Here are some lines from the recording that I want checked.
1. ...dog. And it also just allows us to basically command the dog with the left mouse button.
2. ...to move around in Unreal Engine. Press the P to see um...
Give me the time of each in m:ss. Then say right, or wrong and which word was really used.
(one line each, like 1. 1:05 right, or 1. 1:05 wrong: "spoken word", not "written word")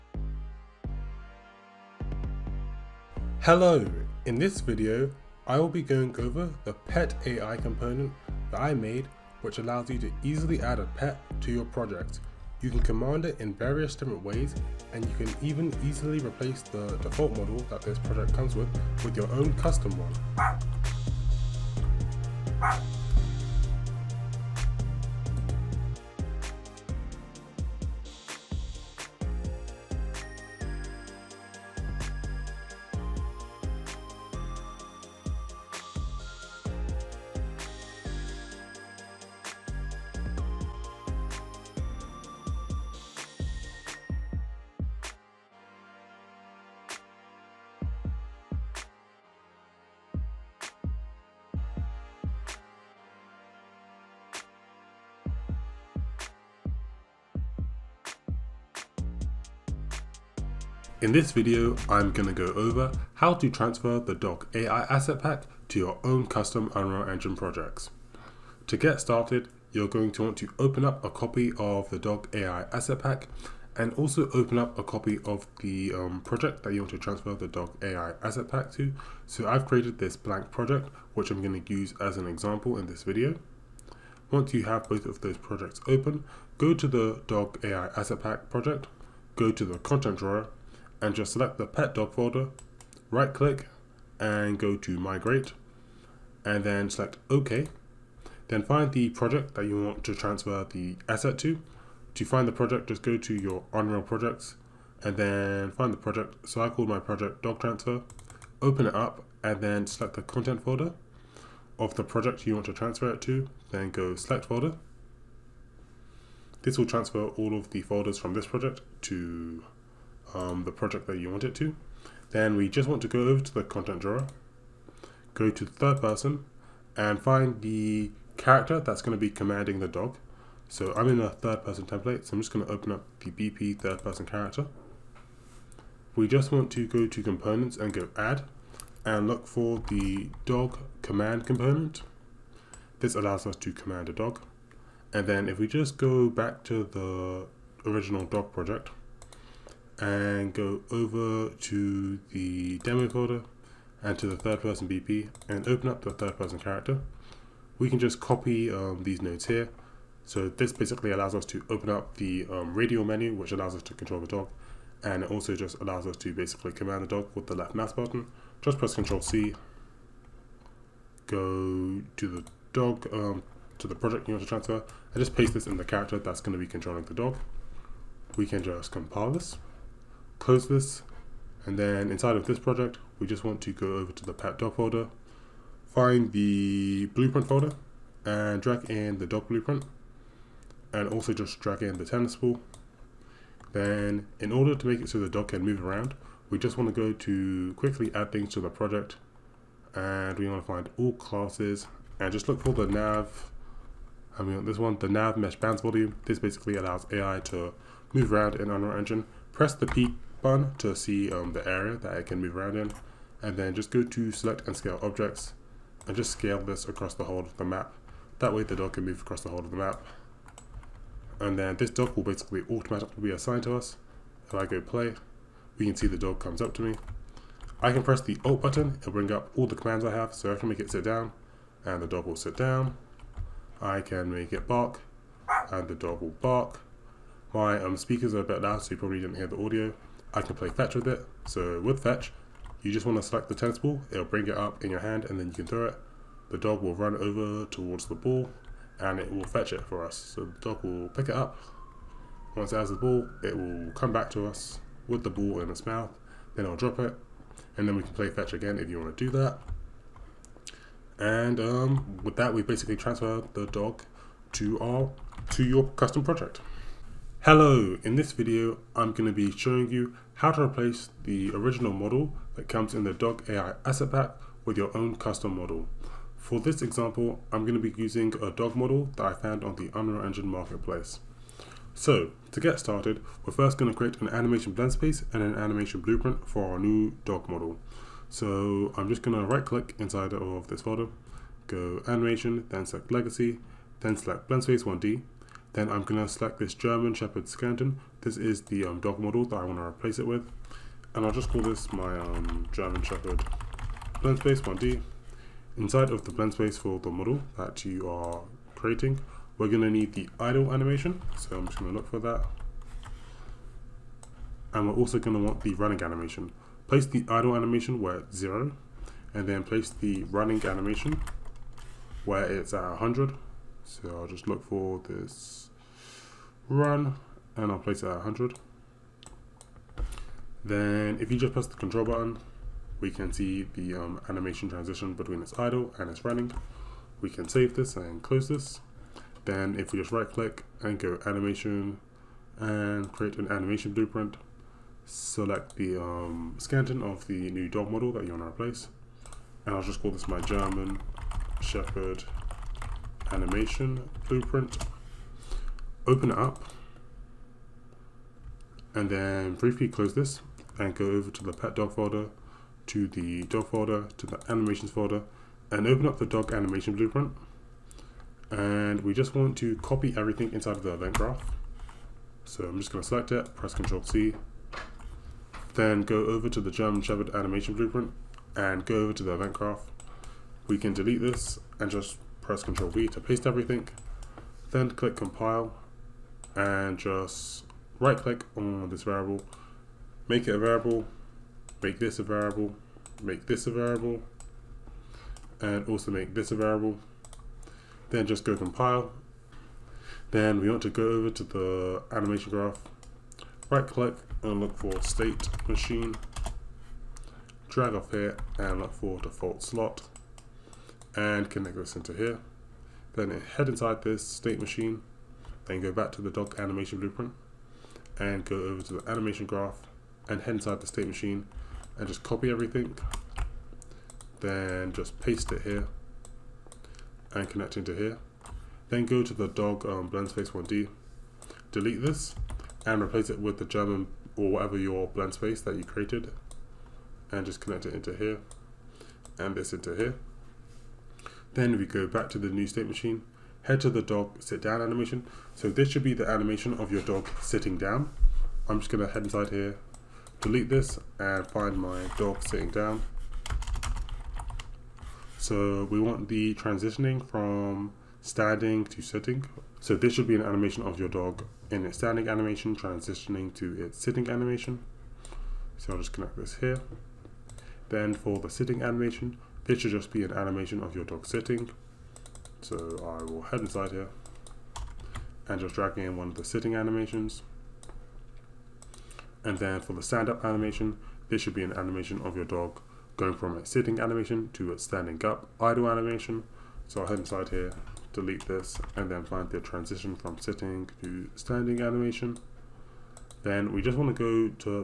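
1. 2:44 right
2. 3:27 right.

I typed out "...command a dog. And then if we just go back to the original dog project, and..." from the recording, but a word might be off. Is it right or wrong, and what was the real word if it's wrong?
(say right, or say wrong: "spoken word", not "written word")
right.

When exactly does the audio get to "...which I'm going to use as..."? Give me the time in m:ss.
1:21.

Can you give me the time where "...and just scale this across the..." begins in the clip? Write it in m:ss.
3:36.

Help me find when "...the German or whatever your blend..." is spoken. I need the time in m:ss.
7:13.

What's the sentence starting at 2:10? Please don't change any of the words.
So I'm in a third person template, so I'm just going to open up the BP third person character.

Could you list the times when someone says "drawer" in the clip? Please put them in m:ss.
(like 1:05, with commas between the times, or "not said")
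1:30, 2:03.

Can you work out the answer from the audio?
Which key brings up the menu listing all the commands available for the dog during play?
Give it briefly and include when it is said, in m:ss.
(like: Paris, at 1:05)
Alt, at 3:48.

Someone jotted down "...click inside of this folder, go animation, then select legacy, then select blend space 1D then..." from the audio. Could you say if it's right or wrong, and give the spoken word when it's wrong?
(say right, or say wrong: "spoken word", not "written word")
right.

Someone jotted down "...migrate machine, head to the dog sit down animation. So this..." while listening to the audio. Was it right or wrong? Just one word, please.
wrong.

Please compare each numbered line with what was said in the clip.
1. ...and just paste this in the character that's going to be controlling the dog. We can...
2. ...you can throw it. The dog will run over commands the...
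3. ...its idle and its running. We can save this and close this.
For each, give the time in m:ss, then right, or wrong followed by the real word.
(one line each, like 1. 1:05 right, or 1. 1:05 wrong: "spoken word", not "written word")
1. 2:54 right
2. 4:05 wrong: "towards", not "commands"
3. 5:35 right.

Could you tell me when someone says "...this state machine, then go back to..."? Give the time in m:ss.
6:54.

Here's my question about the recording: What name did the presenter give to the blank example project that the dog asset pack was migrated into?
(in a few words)
dog transfer.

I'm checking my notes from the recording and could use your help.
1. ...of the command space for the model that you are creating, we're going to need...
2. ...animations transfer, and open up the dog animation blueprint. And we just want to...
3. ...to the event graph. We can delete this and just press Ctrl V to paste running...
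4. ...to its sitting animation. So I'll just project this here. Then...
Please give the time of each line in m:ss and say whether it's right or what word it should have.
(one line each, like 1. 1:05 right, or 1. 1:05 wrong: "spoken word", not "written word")
1. 5:06 wrong: "blend", not "command"
2. 6:04 wrong: "folder", not "transfer"
3. 6:19 wrong: "everything", not "running"
4. 7:43 wrong: "connect", not "project".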